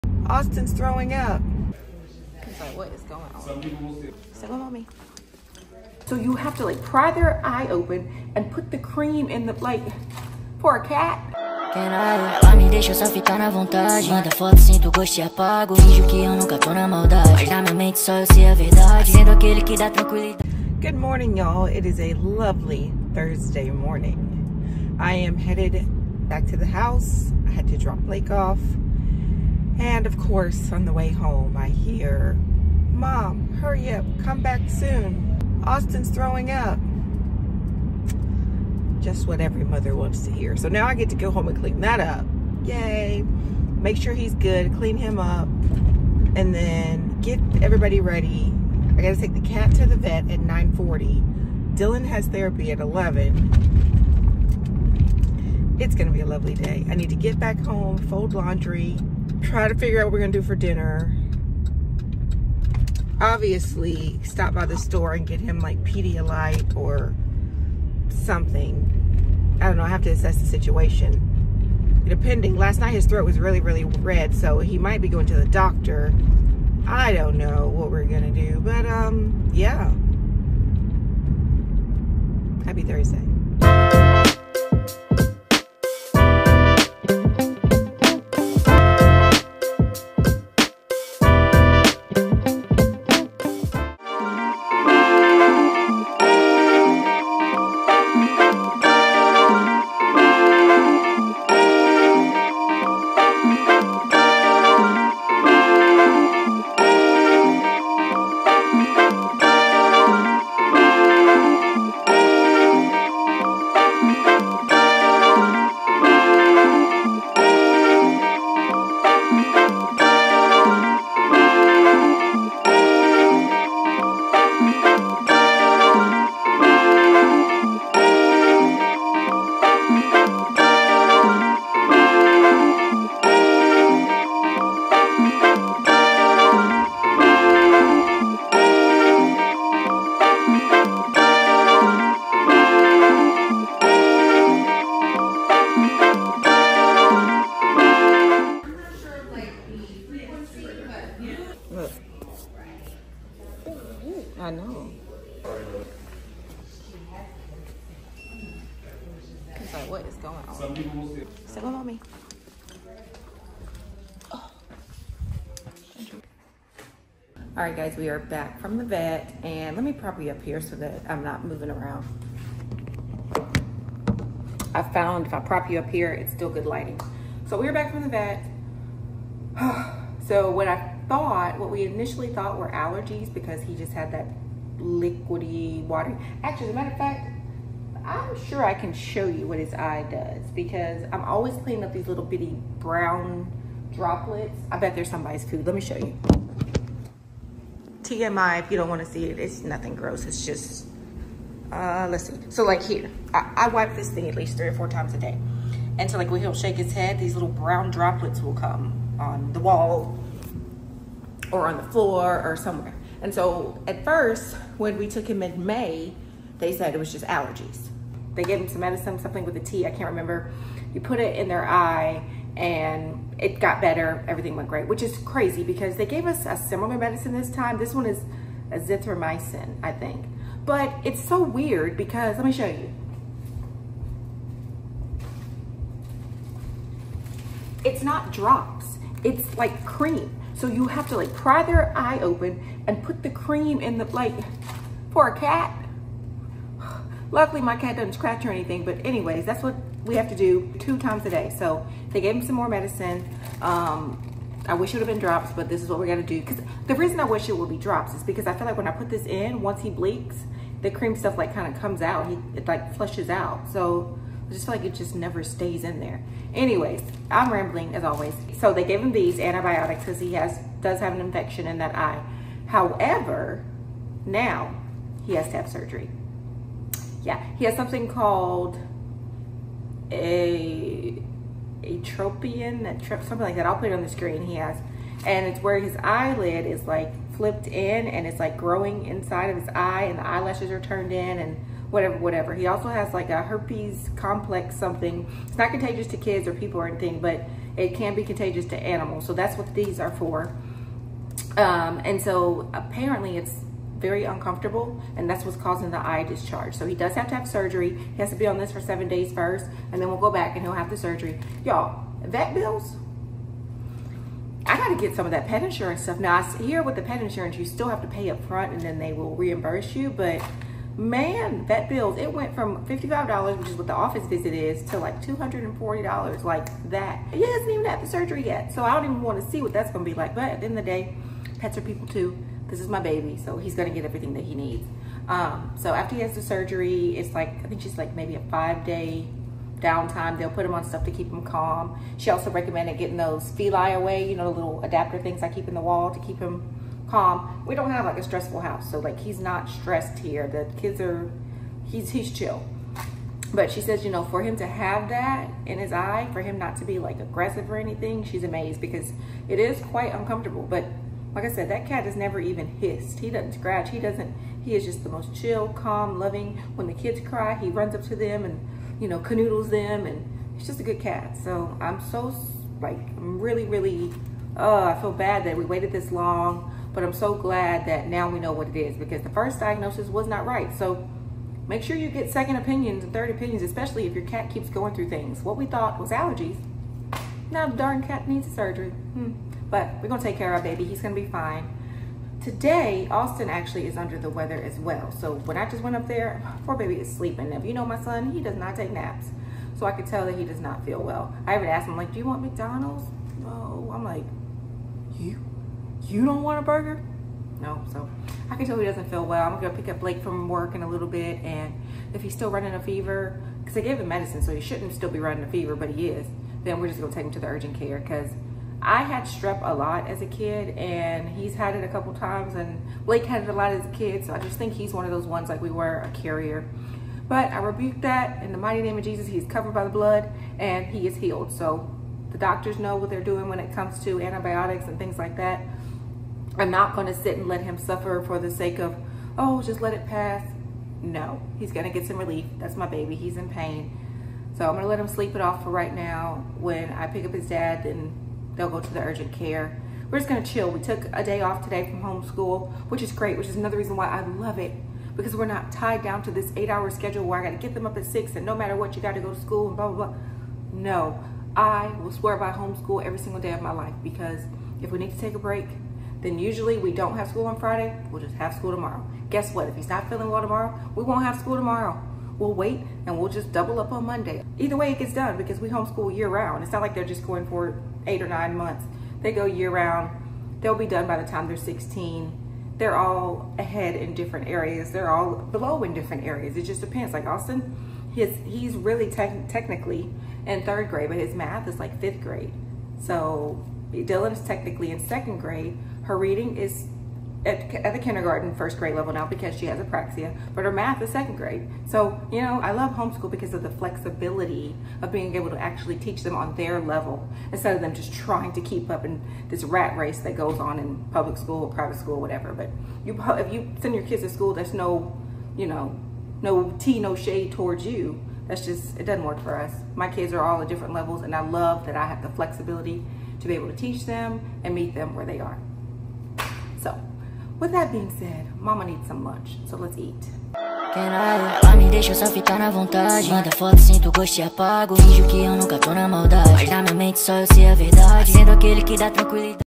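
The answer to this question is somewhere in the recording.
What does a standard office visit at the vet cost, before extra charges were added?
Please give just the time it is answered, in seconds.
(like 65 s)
322 s.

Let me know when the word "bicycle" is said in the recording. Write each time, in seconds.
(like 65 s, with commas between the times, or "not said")
not said.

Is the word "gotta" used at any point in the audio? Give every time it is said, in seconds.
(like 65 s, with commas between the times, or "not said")
49 s, 314 s.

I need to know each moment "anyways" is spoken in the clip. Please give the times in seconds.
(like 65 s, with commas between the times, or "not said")
249 s, 266 s.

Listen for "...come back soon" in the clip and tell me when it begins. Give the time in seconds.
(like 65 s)
34 s.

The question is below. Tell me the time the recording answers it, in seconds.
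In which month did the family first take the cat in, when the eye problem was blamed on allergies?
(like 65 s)
215 s.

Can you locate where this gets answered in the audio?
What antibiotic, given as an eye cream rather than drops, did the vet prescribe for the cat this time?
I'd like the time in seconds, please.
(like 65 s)
228 s.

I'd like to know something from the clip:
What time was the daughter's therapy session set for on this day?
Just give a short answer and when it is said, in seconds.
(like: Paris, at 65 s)
11, at 52 s.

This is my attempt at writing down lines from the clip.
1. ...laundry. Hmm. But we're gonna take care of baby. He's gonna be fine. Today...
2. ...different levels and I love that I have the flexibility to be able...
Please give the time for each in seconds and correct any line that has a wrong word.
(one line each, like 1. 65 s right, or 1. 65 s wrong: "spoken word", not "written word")
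1. 388 s wrong: "surgery", not "laundry"
2. 520 s right.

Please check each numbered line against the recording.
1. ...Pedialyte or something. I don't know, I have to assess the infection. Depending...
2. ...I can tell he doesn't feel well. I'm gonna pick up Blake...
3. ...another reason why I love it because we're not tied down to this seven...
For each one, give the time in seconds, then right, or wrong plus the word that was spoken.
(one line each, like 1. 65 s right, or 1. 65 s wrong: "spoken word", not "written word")
1. 65 s wrong: "situation", not "infection"
2. 408 s right
3. 453 s wrong: "eight", not "seven".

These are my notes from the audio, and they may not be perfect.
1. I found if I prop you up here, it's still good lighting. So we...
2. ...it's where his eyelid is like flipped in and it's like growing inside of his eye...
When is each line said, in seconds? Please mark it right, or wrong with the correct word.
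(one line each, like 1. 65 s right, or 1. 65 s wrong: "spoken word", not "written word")
1. 174 s right
2. 285 s right.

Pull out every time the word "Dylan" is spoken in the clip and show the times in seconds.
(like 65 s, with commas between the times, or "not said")
51 s, 493 s.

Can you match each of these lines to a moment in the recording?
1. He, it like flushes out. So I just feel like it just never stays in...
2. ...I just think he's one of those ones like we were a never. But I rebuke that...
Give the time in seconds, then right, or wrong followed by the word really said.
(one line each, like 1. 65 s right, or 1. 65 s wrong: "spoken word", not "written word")
1. 262 s right
2. 424 s wrong: "carrier", not "never".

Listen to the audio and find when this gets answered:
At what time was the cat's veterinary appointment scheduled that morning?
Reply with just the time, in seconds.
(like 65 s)
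50 s.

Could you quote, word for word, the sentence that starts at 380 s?
So make sure you get second opinions and third opinions, especially if your cat keeps going through things.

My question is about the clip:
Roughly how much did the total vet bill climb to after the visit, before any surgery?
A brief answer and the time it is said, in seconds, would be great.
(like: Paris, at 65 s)
$240, at 325 s.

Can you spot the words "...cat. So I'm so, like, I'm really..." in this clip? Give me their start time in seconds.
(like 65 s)
371 s.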